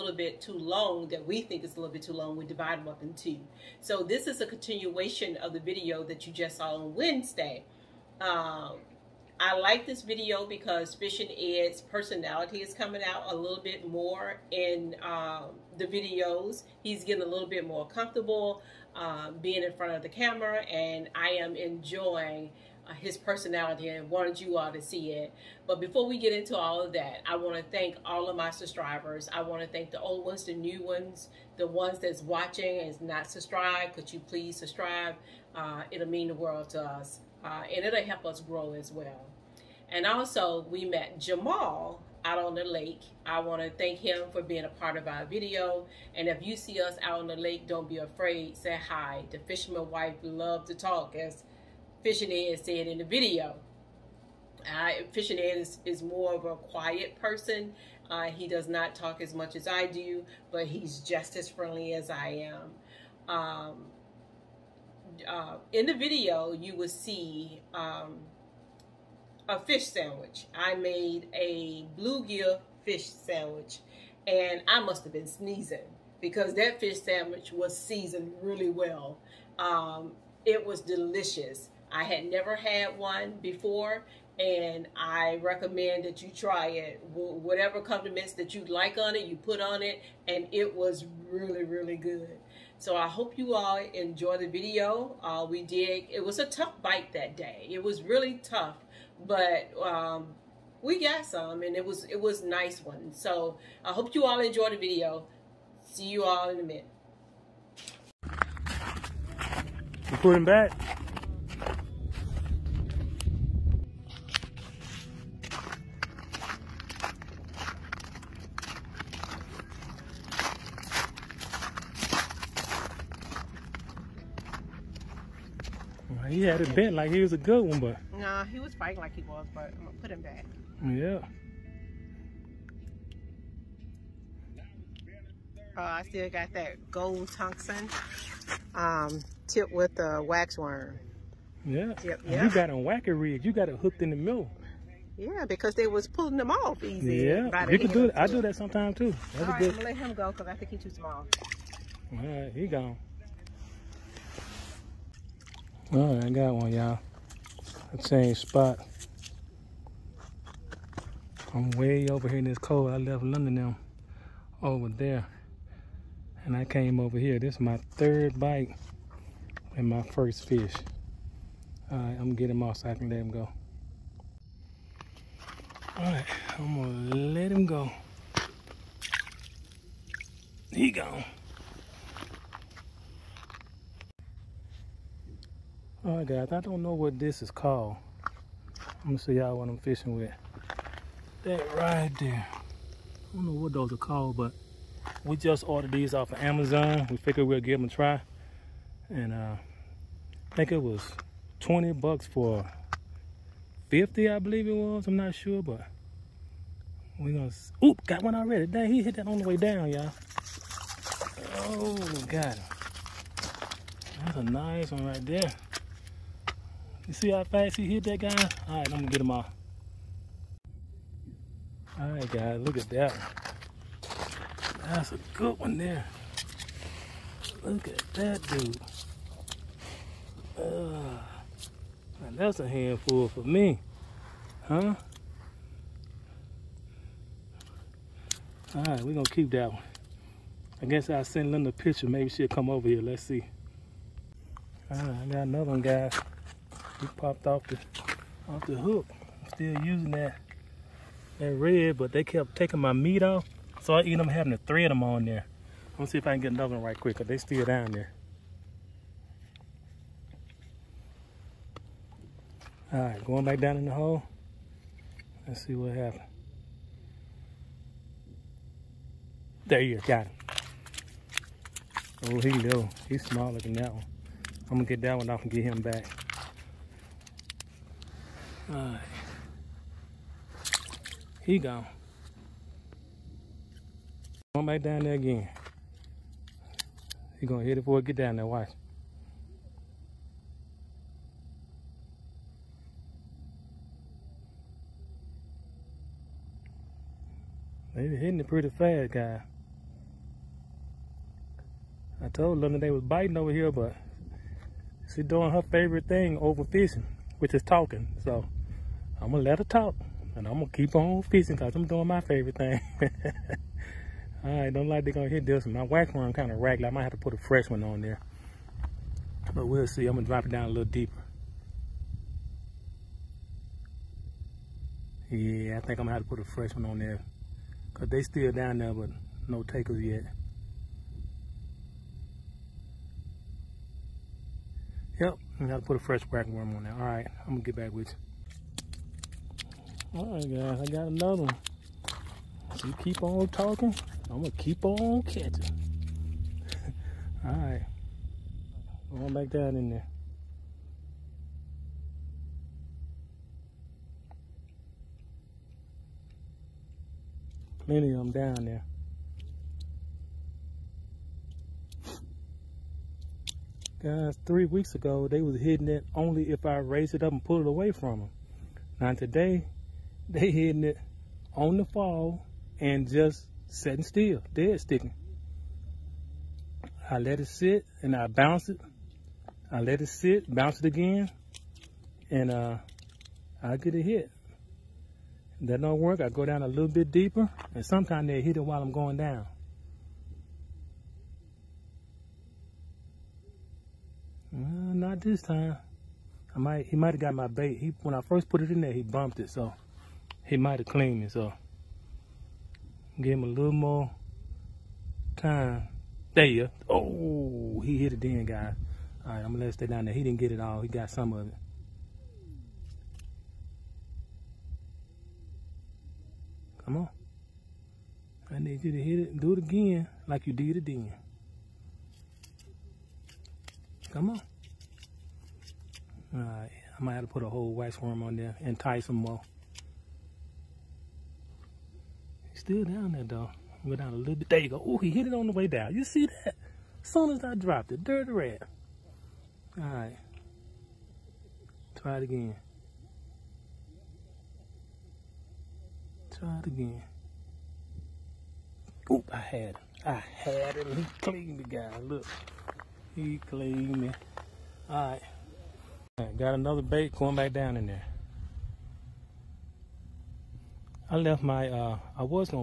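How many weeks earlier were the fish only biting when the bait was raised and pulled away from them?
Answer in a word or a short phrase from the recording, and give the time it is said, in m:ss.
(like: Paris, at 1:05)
3, at 6:04.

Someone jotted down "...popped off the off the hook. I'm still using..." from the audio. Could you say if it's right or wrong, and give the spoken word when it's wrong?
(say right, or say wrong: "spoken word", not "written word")
right.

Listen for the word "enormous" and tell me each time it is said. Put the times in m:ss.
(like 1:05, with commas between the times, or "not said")
not said.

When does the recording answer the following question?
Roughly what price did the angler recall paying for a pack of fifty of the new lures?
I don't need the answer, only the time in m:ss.
3:21.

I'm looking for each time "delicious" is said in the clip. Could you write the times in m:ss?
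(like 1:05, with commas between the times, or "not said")
1:20.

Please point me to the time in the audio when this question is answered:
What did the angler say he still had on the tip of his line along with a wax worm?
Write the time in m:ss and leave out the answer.
2:16.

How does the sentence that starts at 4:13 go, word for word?
So I eat them having to thread them on there.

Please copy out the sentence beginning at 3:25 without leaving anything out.
I'm not sure, but we gonna, oop, got one already.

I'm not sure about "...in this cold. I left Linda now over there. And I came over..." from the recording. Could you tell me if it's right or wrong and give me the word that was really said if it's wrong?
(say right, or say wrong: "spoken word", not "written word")
right.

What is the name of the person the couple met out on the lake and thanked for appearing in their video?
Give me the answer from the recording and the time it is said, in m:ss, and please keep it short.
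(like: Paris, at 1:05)
Jamal, at 0:41.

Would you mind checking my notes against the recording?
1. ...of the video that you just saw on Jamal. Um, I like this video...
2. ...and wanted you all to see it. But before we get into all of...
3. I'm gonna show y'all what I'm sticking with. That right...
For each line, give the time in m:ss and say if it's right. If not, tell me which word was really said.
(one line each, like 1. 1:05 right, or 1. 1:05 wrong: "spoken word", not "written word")
1. 0:05 wrong: "Wednesday", not "Jamal"
2. 0:23 right
3. 3:09 wrong: "fishing", not "sticking".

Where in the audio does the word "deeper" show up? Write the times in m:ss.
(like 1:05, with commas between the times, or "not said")
5:20, 6:27.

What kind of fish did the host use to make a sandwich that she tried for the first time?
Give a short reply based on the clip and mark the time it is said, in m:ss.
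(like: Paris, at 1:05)
Bluegill, at 1:11.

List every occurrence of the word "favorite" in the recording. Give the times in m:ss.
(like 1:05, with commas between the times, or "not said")
5:05, 5:12.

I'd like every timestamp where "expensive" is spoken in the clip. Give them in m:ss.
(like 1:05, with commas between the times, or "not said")
not said.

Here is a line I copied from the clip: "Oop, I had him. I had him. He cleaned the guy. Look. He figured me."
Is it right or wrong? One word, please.
wrong.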